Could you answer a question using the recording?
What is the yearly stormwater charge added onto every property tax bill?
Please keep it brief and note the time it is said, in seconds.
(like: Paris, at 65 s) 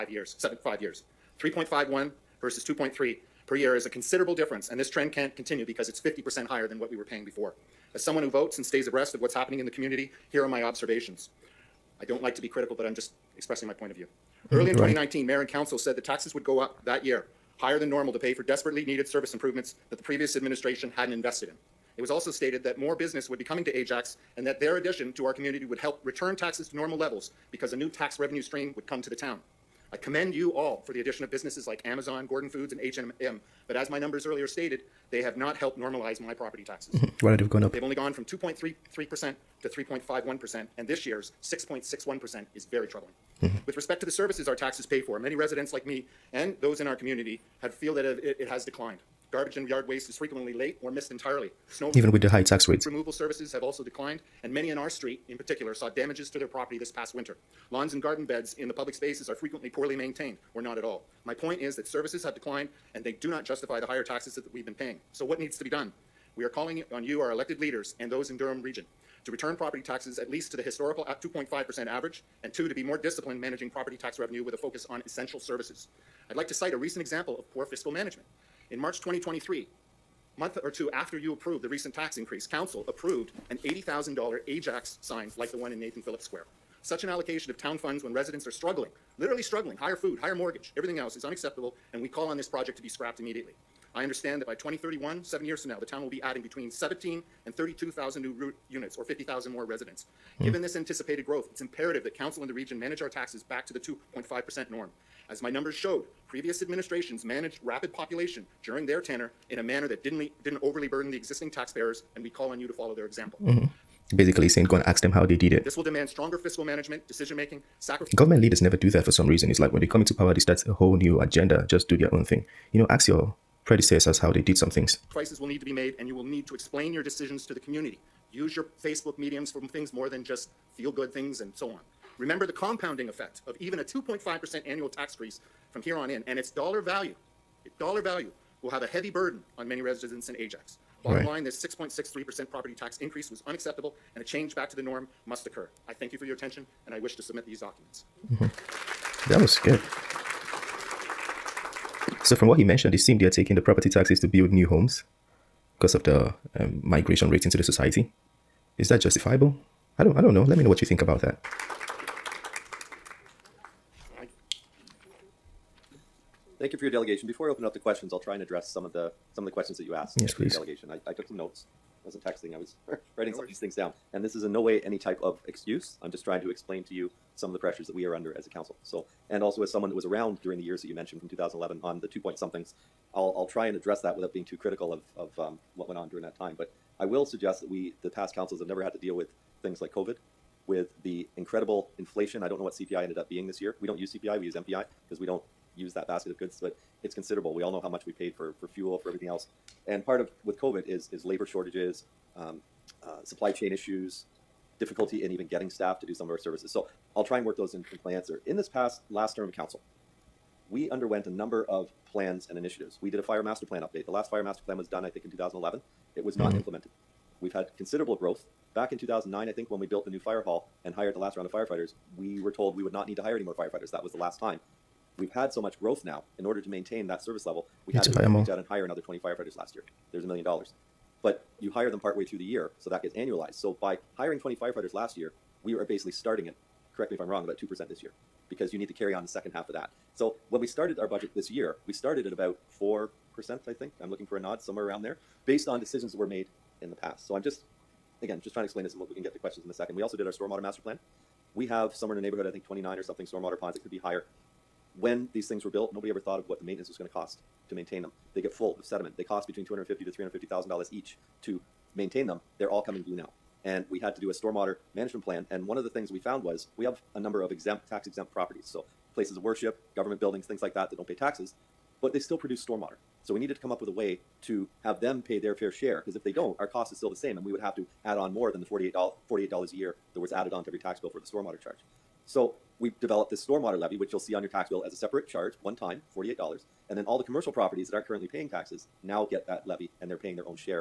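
$48, at 279 s.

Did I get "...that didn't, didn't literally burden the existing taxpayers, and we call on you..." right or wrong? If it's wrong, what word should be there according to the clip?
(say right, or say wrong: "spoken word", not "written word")
wrong: "overly", not "literally".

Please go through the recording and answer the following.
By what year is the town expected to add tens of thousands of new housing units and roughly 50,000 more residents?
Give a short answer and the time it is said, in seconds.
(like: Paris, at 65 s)
2031, at 94 s.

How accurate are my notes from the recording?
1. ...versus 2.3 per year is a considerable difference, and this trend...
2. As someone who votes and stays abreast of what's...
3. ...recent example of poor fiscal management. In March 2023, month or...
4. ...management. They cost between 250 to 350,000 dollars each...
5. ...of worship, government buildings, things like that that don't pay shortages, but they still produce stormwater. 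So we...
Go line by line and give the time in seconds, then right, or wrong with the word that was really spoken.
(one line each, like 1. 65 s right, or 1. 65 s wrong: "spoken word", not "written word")
1. 2 s right
2. 7 s right
3. 76 s right
4. 258 s wrong: "sediment", not "management"
5. 269 s wrong: "taxes", not "shortages".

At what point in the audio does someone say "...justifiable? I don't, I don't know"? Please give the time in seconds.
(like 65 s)
159 s.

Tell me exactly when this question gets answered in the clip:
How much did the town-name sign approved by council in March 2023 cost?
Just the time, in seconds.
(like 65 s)
83 s.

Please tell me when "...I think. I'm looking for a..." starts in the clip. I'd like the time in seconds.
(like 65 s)
243 s.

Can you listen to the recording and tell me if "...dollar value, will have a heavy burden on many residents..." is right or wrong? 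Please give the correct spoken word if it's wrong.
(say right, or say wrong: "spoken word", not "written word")
right.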